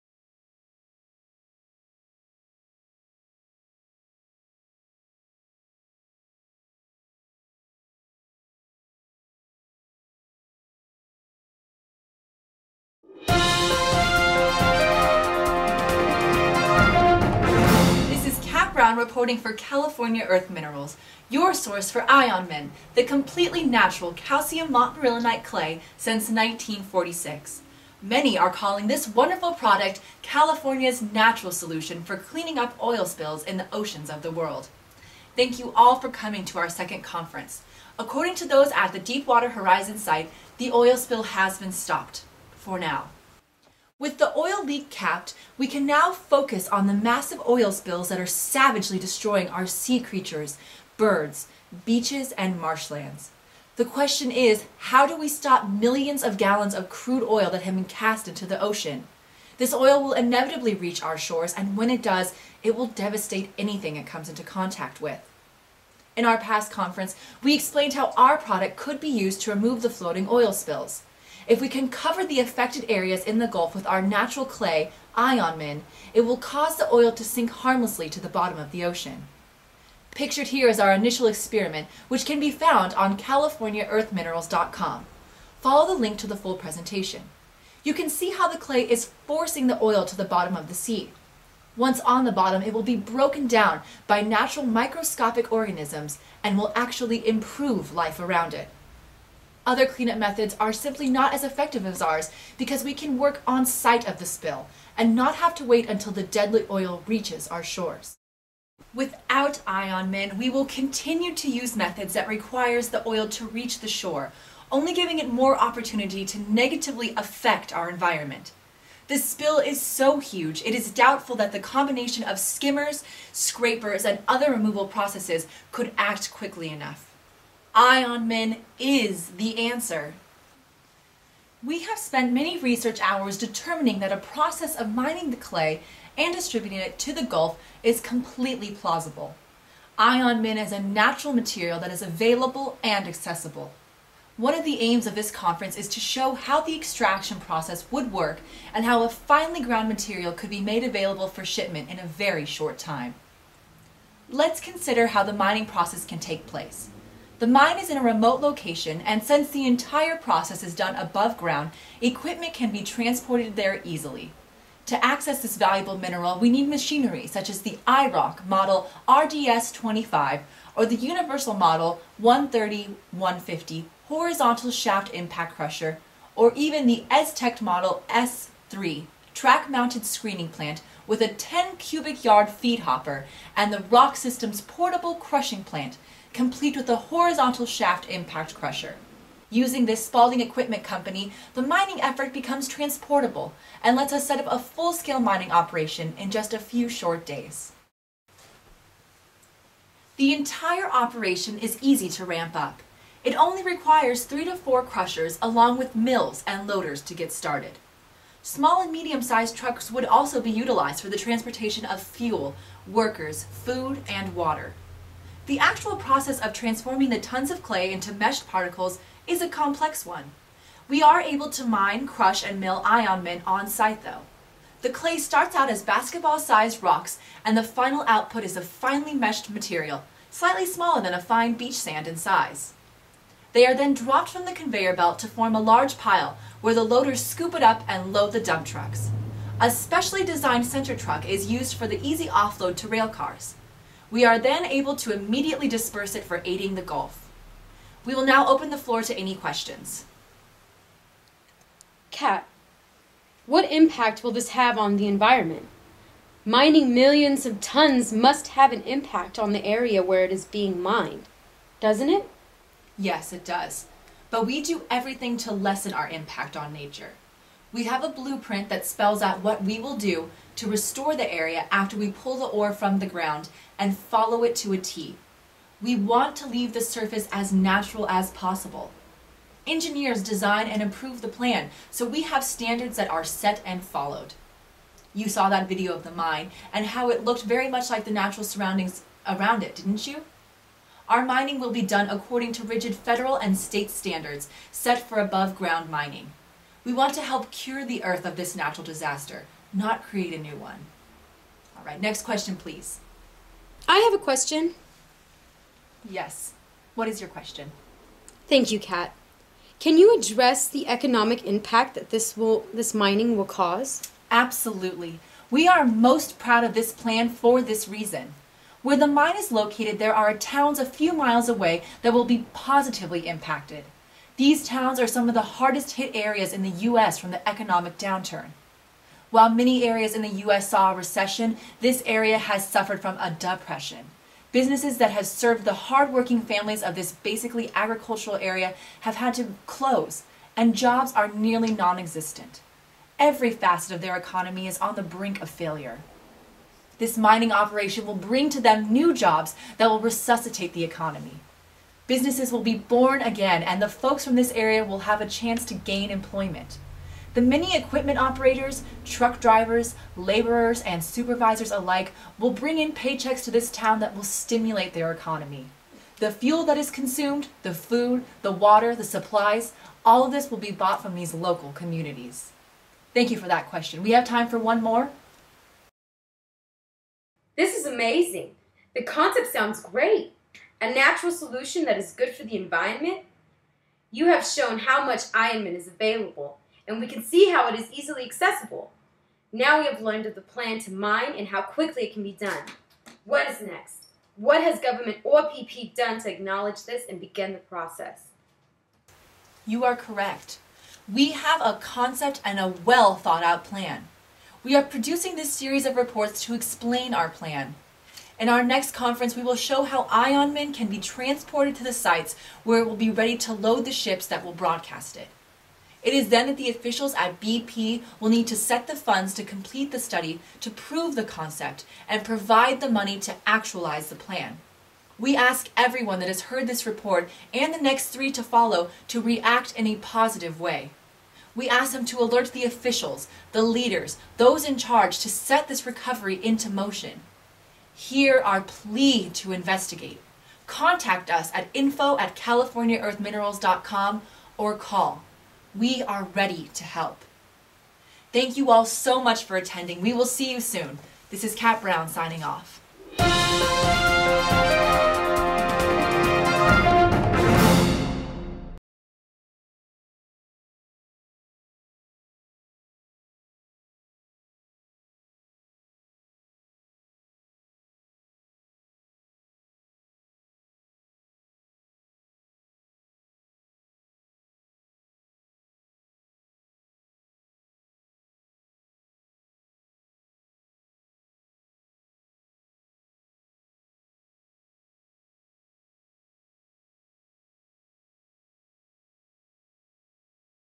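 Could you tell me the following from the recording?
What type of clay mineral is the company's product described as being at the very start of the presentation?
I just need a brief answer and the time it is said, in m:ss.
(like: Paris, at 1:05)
calcium montmorillonite, at 0:24.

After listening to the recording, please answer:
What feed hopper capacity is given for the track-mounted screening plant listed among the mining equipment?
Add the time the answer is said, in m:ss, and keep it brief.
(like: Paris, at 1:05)
10 cubic yards, at 3:01.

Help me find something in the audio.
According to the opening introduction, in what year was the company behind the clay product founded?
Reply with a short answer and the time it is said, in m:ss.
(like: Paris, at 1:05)
1946, at 0:26.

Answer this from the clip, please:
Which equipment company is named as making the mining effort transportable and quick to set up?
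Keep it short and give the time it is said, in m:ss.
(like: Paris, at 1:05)
Spalding Equipment Company, at 3:10.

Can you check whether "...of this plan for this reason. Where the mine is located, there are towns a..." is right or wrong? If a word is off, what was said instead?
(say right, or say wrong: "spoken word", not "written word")
right.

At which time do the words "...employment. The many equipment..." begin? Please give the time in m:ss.
5:56.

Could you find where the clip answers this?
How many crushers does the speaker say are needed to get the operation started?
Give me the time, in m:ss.
3:24.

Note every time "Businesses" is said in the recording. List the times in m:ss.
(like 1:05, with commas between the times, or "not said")
5:34, 5:52.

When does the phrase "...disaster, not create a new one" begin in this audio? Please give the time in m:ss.
4:58.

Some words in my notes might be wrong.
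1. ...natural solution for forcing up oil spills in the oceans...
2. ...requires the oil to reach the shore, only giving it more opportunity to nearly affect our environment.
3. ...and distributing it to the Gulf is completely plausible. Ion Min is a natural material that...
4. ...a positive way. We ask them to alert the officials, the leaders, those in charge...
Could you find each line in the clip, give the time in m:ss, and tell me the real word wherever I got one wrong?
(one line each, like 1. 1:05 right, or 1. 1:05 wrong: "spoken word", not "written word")
1. 0:31 wrong: "cleaning", not "forcing"
2. 1:52 wrong: "negatively", not "nearly"
3. 2:16 right
4. 7:09 right.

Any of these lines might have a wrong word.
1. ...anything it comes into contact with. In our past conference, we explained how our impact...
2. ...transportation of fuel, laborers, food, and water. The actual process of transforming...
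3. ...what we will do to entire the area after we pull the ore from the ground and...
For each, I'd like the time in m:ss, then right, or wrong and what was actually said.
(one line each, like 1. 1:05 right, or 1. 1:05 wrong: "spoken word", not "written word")
1. 1:03 wrong: "product", not "impact"
2. 3:31 wrong: "workers", not "laborers"
3. 4:29 wrong: "restore", not "entire".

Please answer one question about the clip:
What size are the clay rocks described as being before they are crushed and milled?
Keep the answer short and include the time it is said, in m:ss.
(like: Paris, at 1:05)
Basketball-sized, at 3:45.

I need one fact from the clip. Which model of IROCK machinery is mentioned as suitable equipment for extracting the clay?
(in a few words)
RDS-25.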